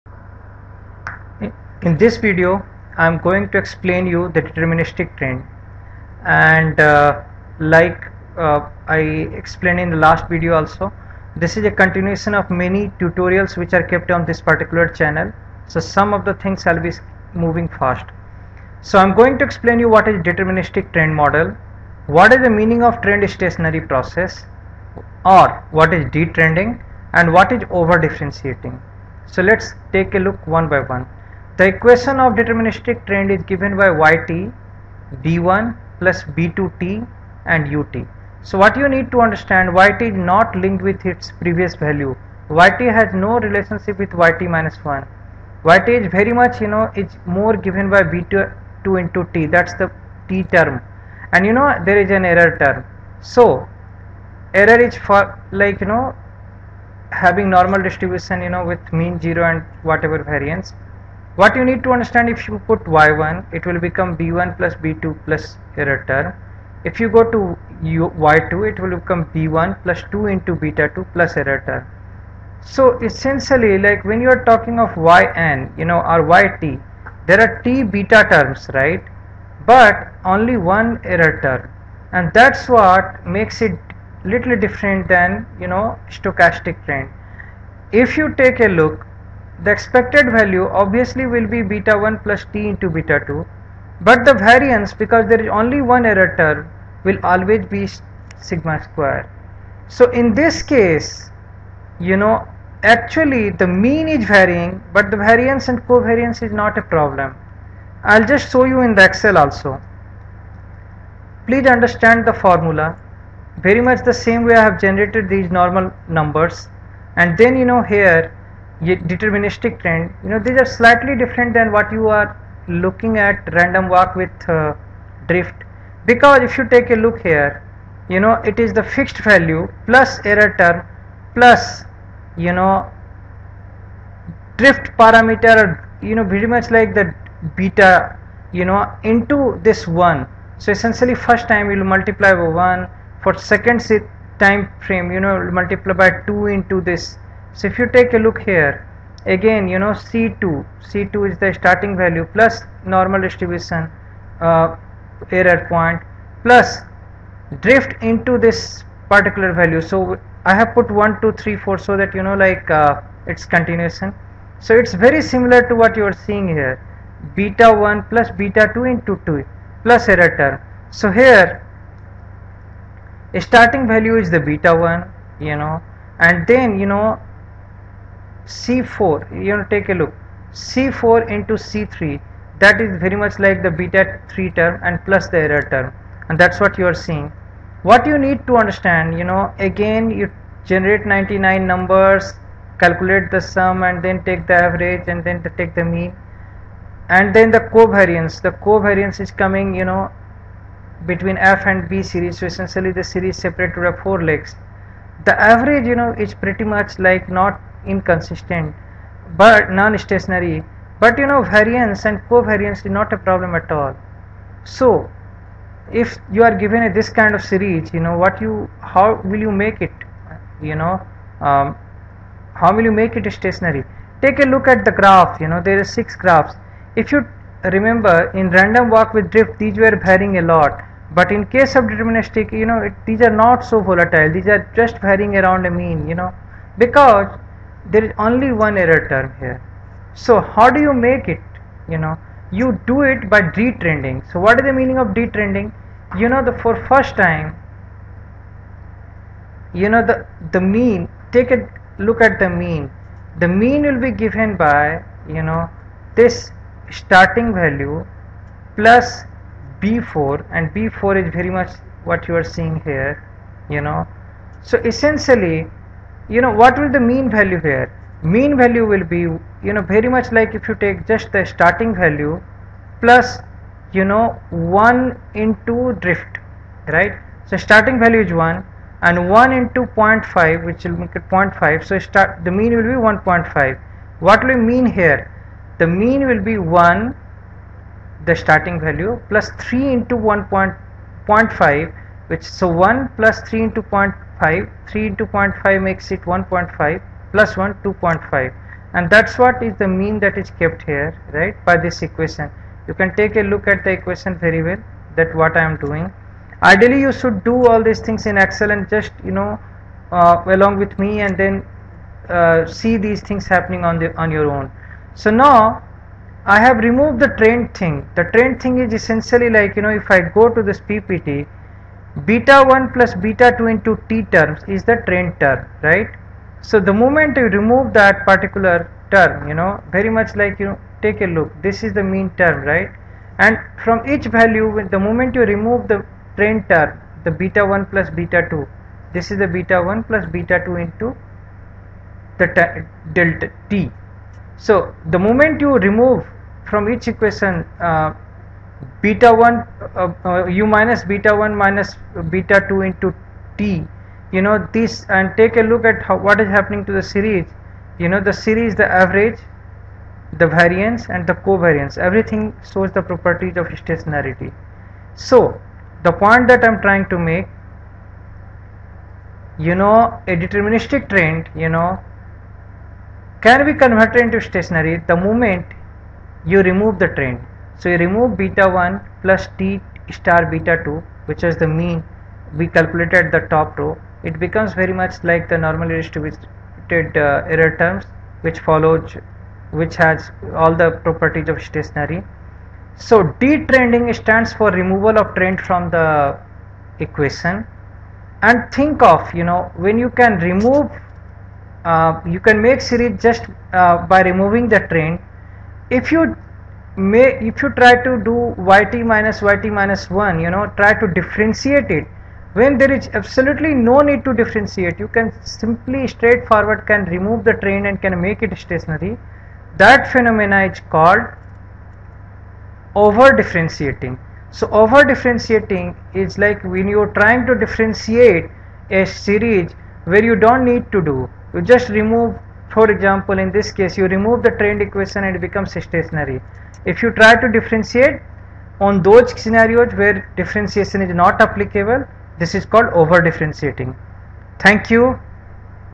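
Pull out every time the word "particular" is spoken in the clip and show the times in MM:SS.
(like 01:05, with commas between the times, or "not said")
00:14, 02:39, 05:28.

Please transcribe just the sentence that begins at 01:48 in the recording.
I'll just show you in the excel also.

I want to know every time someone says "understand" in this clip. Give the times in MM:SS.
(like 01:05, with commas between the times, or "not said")
00:39, 01:01, 01:51, 03:08.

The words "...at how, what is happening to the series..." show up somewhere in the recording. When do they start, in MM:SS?
05:55.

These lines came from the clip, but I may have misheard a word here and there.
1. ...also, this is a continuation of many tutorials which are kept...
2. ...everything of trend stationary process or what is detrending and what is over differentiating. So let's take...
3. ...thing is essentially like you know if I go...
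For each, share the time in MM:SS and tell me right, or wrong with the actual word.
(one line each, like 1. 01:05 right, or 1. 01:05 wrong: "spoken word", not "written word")
1. 00:10 right
2. 00:22 wrong: "meaning", not "everything"
3. 05:18 right.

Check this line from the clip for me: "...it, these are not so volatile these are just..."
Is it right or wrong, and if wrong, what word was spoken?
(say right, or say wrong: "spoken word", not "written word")
right.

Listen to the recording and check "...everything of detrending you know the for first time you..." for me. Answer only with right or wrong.
wrong.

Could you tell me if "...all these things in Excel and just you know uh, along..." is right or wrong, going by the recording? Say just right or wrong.
right.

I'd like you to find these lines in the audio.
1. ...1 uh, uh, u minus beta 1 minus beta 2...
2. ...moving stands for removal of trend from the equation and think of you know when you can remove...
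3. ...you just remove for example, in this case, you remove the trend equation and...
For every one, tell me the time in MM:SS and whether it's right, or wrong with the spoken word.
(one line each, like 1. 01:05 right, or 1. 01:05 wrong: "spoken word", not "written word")
1. 05:49 right
2. 06:33 wrong: "detrending", not "moving"
3. 07:11 right.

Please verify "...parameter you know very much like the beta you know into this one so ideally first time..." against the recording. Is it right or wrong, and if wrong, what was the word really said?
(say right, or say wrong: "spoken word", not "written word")
wrong: "essentially", not "ideally".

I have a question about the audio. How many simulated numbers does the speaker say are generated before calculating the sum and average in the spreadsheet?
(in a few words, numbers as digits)
99.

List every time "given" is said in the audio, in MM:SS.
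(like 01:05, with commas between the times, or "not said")
00:33, 00:47, 03:36, 04:14.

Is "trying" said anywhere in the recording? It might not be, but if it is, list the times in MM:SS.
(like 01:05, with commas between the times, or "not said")
06:06, 07:07.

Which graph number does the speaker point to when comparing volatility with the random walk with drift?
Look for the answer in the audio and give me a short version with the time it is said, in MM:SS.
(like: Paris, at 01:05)
6, at 03:45.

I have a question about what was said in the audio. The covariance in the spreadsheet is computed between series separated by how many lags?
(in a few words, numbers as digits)
4.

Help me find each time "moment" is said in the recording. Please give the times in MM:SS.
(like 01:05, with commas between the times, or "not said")
05:26, 05:34, 05:45, 06:15.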